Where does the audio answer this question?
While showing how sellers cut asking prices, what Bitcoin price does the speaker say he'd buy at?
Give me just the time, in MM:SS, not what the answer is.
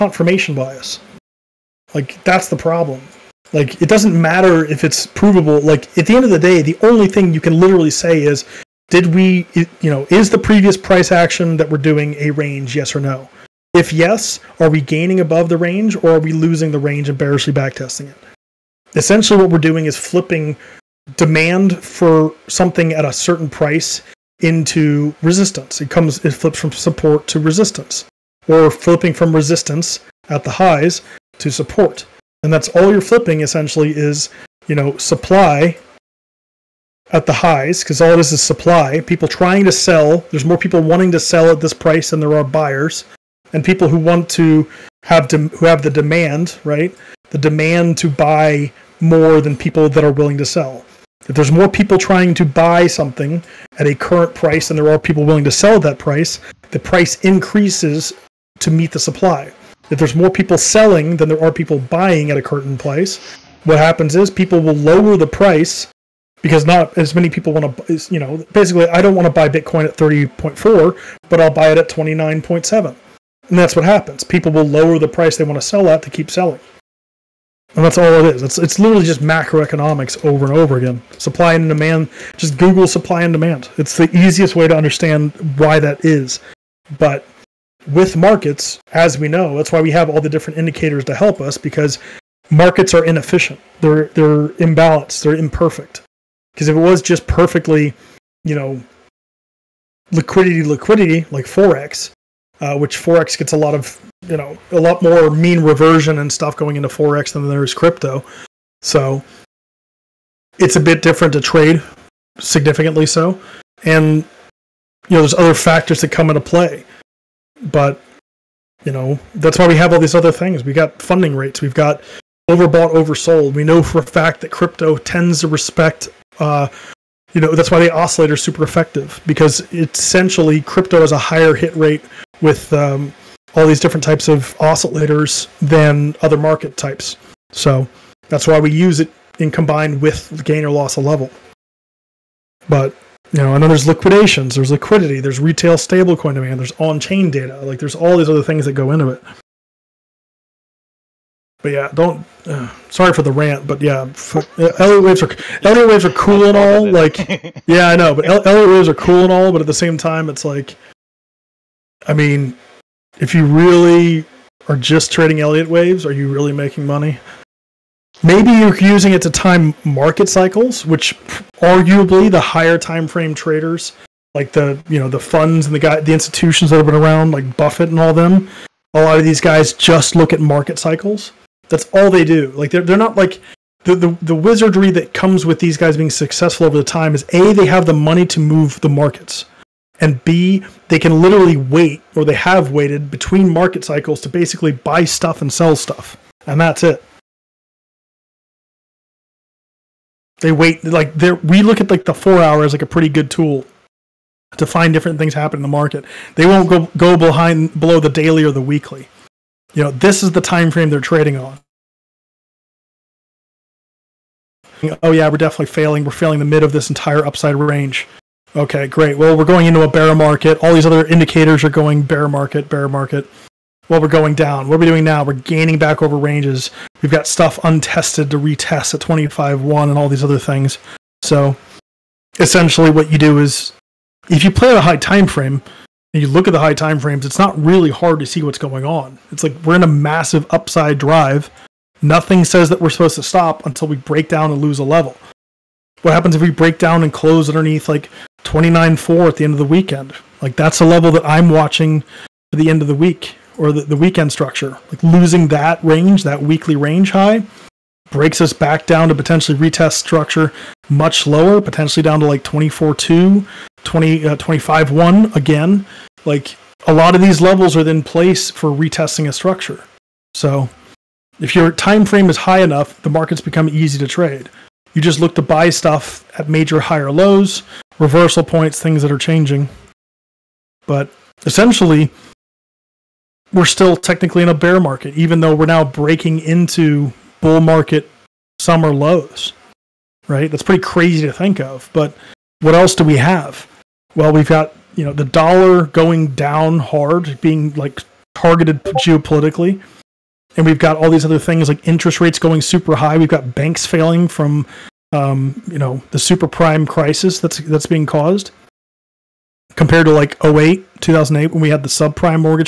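01:11.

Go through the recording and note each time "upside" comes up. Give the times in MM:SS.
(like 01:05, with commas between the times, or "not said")
03:37, 04:00.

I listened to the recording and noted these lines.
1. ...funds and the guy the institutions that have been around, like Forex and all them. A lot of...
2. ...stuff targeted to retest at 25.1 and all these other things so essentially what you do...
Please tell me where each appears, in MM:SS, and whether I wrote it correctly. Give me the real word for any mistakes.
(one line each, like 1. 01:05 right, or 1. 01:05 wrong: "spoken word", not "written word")
1. 02:55 wrong: "Buffett", not "Forex"
2. 03:47 wrong: "untested", not "targeted".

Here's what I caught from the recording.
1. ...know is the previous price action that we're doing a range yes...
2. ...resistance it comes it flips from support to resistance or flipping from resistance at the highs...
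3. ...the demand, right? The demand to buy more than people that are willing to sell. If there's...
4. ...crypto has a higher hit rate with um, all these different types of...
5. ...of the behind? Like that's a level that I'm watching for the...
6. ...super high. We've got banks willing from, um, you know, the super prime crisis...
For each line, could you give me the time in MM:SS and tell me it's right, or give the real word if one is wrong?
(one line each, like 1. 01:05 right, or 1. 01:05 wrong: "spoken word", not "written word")
1. 00:09 right
2. 00:25 right
3. 00:45 right
4. 02:10 right
5. 04:09 wrong: "weekend", not "behind"
6. 05:02 wrong: "failing", not "willing".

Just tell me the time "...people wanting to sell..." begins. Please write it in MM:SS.
00:40.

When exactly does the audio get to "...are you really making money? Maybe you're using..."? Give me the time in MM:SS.
02:46.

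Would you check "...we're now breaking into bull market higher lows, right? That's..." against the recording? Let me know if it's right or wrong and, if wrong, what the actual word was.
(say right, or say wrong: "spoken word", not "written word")
wrong: "summer", not "higher".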